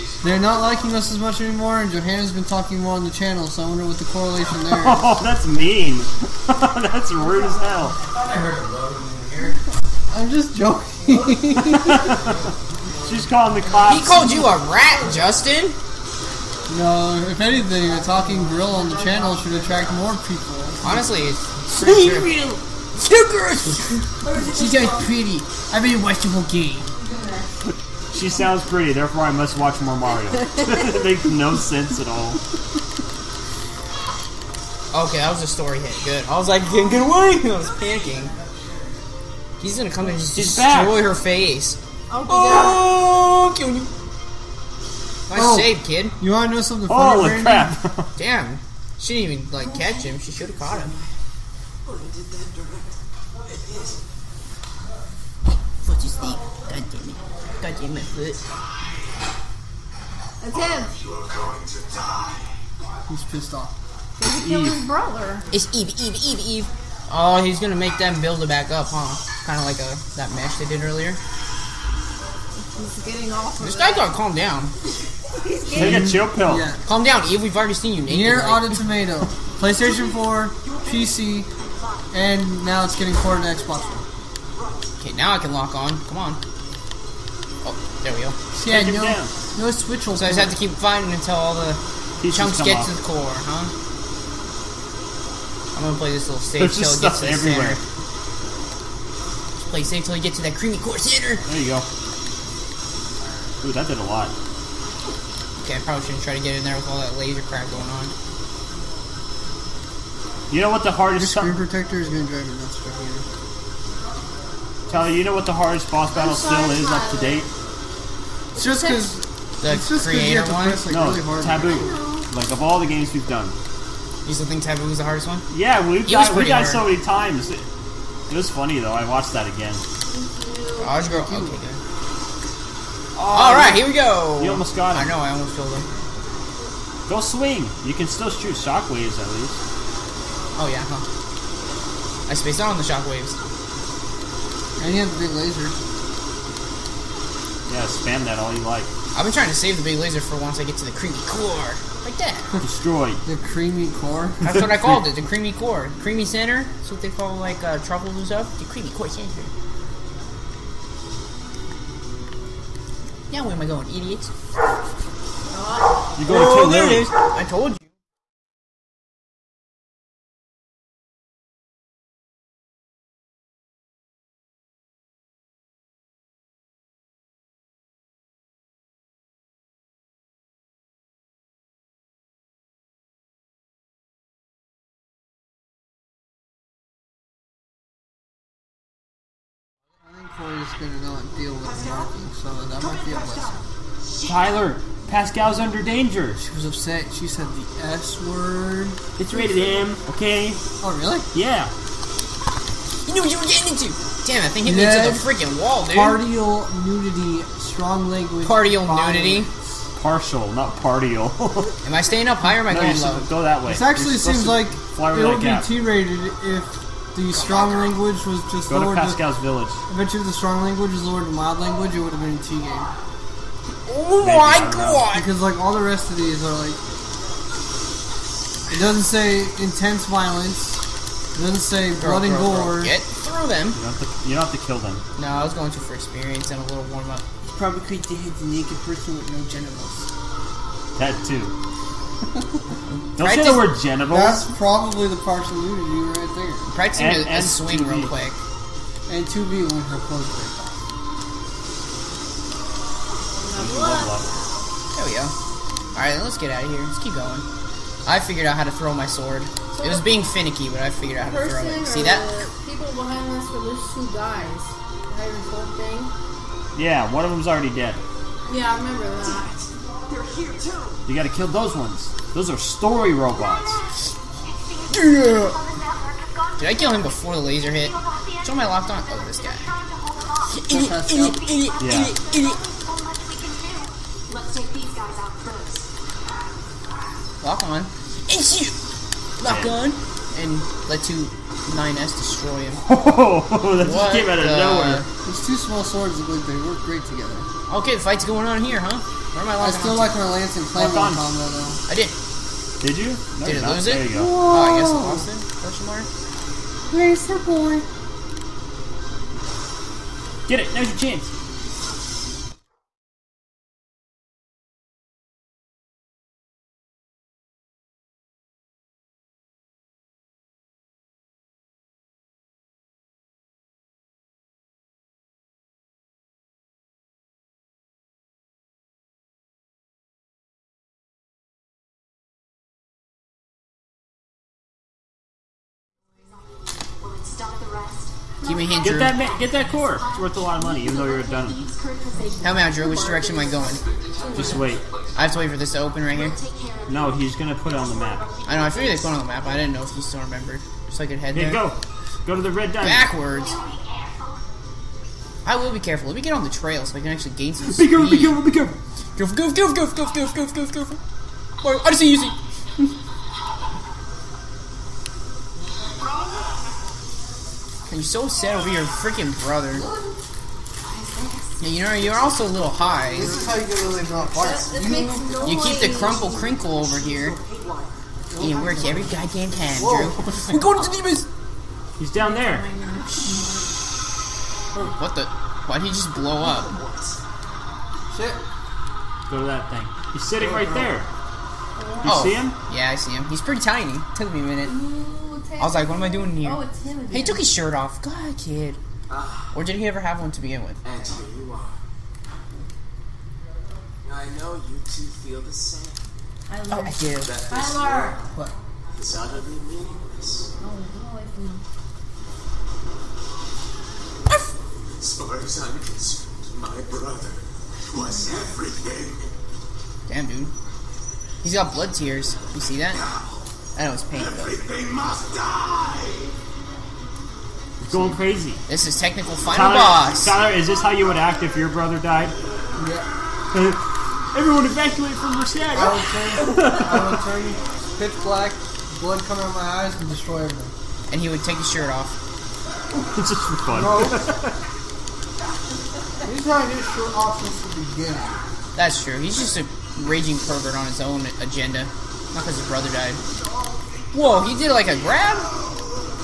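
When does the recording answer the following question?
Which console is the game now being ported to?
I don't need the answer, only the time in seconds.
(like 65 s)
83 s.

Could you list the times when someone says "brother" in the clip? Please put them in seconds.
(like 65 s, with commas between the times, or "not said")
64 s, 369 s, 416 s, 431 s, 452 s.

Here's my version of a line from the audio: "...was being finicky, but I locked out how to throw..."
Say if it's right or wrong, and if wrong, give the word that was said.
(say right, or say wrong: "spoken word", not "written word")
wrong: "figured", not "locked".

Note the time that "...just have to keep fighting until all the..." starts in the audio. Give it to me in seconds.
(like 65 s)
90 s.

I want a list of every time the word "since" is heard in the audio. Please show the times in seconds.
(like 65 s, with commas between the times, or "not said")
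447 s.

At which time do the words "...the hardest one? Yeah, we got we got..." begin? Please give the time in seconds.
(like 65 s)
124 s.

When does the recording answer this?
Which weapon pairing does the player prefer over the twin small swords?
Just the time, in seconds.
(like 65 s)
300 s.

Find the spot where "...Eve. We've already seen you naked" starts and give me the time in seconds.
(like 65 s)
77 s.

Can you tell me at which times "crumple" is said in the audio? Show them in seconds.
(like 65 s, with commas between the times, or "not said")
375 s.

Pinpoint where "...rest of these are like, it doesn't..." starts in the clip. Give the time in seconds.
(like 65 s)
225 s.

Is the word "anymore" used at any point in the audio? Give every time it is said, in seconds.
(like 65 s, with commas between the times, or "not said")
1 s.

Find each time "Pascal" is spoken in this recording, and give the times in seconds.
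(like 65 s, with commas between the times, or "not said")
195 s, 219 s.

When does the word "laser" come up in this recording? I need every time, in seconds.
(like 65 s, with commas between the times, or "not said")
107 s, 145 s, 149 s, 277 s.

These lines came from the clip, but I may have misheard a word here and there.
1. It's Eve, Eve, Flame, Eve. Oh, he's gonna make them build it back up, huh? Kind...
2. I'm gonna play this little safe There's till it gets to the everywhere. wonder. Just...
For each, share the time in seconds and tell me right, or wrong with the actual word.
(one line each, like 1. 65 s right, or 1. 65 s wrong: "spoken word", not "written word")
1. 65 s wrong: "Eve", not "Flame"
2. 95 s wrong: "center", not "wonder".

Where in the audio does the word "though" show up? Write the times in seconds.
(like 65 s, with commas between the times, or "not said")
128 s, 301 s, 340 s.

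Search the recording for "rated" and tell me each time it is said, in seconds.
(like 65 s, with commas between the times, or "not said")
199 s, 215 s.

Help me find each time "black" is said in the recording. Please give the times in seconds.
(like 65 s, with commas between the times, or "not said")
438 s.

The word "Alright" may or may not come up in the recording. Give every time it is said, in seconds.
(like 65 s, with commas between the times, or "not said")
255 s.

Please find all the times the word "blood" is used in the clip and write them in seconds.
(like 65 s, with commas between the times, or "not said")
231 s, 421 s, 438 s.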